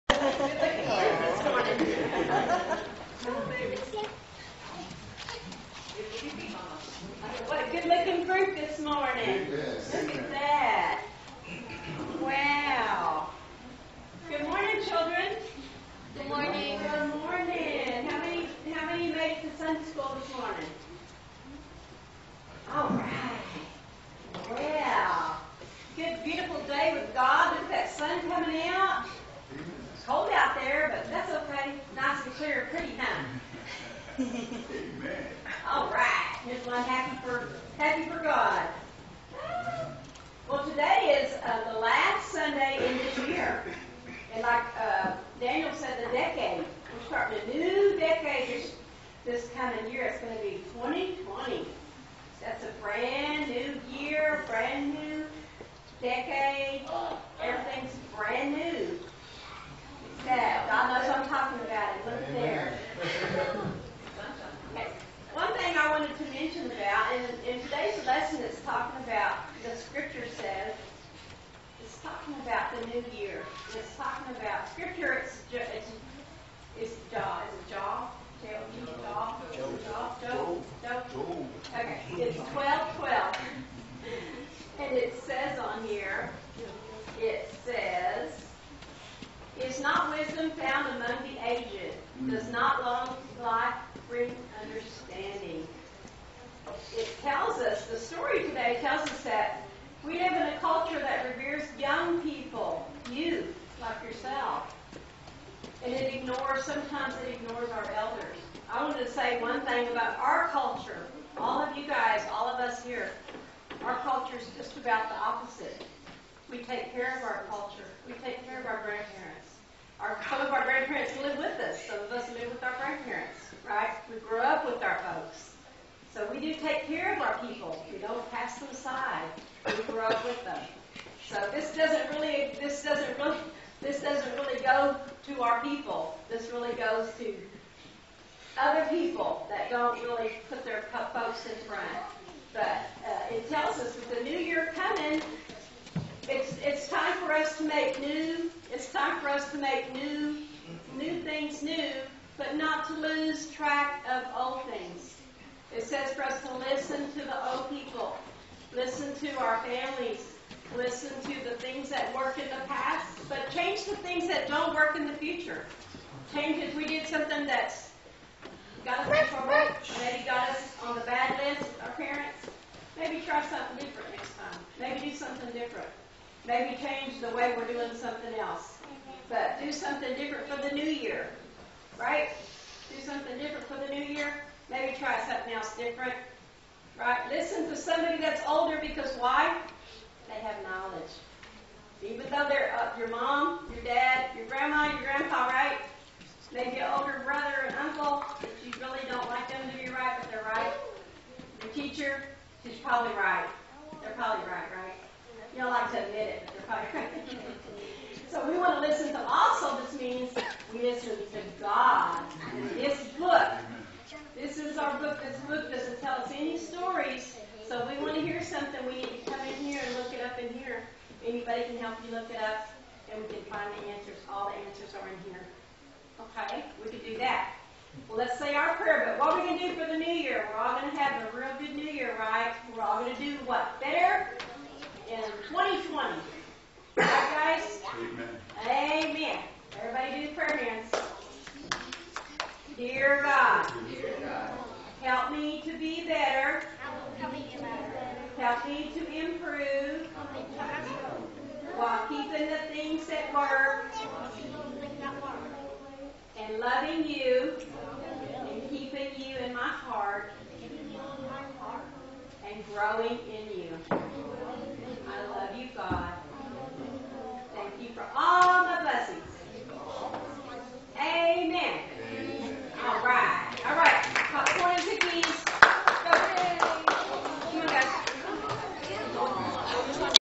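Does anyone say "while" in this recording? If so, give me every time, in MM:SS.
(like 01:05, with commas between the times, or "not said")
04:11.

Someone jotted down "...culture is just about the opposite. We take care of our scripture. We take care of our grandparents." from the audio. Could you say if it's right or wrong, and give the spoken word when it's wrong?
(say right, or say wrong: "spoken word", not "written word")
wrong: "culture", not "scripture".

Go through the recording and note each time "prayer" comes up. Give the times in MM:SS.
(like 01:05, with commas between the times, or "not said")
03:48, 04:00.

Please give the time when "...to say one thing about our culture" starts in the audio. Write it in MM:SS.
01:49.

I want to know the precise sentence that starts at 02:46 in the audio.
Change if we did something that's got us in trouble, maybe got us on the bad list, our parents.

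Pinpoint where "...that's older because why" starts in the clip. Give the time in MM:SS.
03:08.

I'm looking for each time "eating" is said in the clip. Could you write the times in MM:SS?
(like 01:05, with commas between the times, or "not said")
not said.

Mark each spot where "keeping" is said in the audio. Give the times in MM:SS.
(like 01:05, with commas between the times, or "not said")
04:12, 04:18.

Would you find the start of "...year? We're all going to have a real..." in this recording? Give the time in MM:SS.
03:50.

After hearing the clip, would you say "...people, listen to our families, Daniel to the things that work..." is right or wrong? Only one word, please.
wrong.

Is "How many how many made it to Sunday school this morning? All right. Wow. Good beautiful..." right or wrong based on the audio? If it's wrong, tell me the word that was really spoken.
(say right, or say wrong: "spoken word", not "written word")
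right.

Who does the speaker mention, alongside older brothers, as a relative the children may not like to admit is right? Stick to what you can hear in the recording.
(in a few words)
uncle.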